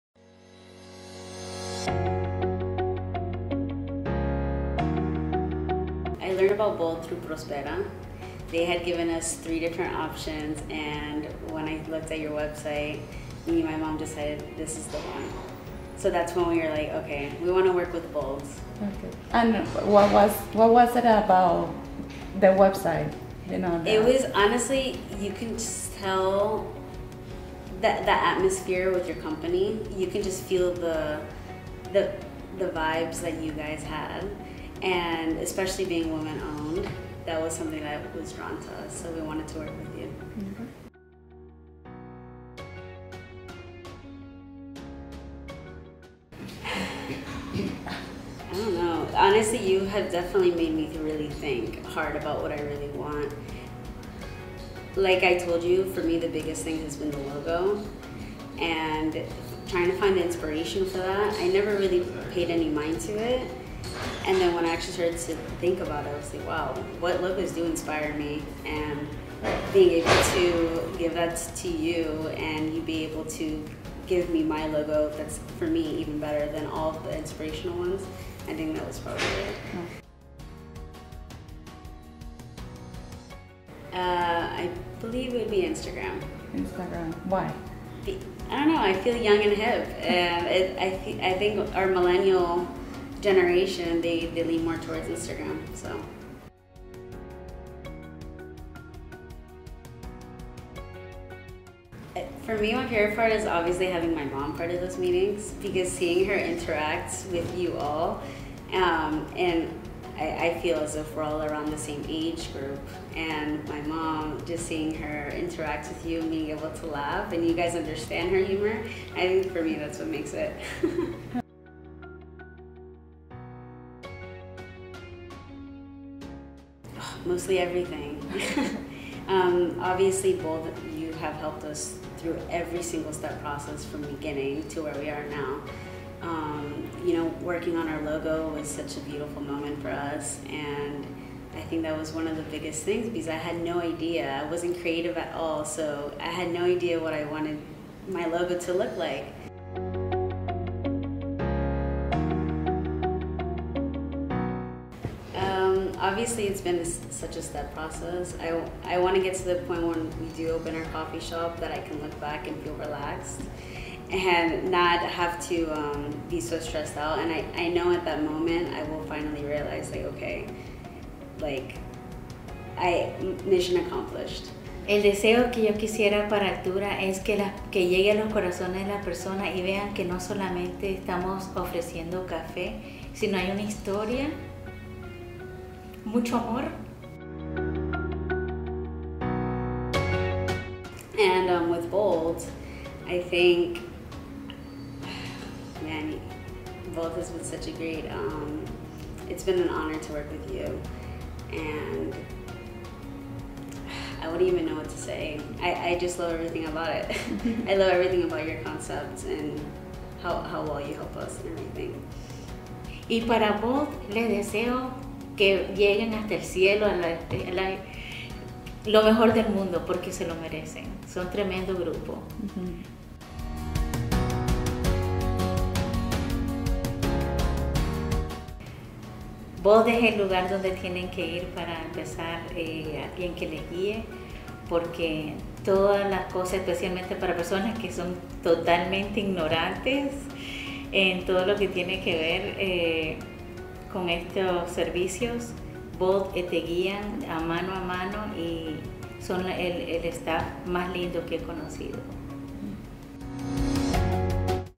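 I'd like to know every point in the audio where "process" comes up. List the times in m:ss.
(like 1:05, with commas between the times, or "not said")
2:13, 2:37.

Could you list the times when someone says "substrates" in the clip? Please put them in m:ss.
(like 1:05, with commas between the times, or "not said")
not said.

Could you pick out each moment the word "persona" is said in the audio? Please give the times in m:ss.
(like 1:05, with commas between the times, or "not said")
2:59, 3:57.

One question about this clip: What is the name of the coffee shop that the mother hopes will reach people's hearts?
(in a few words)
Altura.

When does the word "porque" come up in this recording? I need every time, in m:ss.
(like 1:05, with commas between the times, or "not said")
3:39, 3:54.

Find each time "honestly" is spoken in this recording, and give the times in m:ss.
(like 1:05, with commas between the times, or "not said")
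0:24, 0:49.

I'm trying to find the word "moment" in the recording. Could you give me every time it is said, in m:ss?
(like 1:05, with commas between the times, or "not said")
2:19, 2:48.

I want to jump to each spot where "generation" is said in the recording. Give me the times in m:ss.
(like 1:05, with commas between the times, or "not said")
1:33.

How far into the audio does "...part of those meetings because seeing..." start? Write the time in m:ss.
1:44.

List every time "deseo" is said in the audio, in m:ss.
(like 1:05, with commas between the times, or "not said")
2:55, 3:34.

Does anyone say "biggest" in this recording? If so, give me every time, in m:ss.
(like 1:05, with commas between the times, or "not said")
0:56, 2:22.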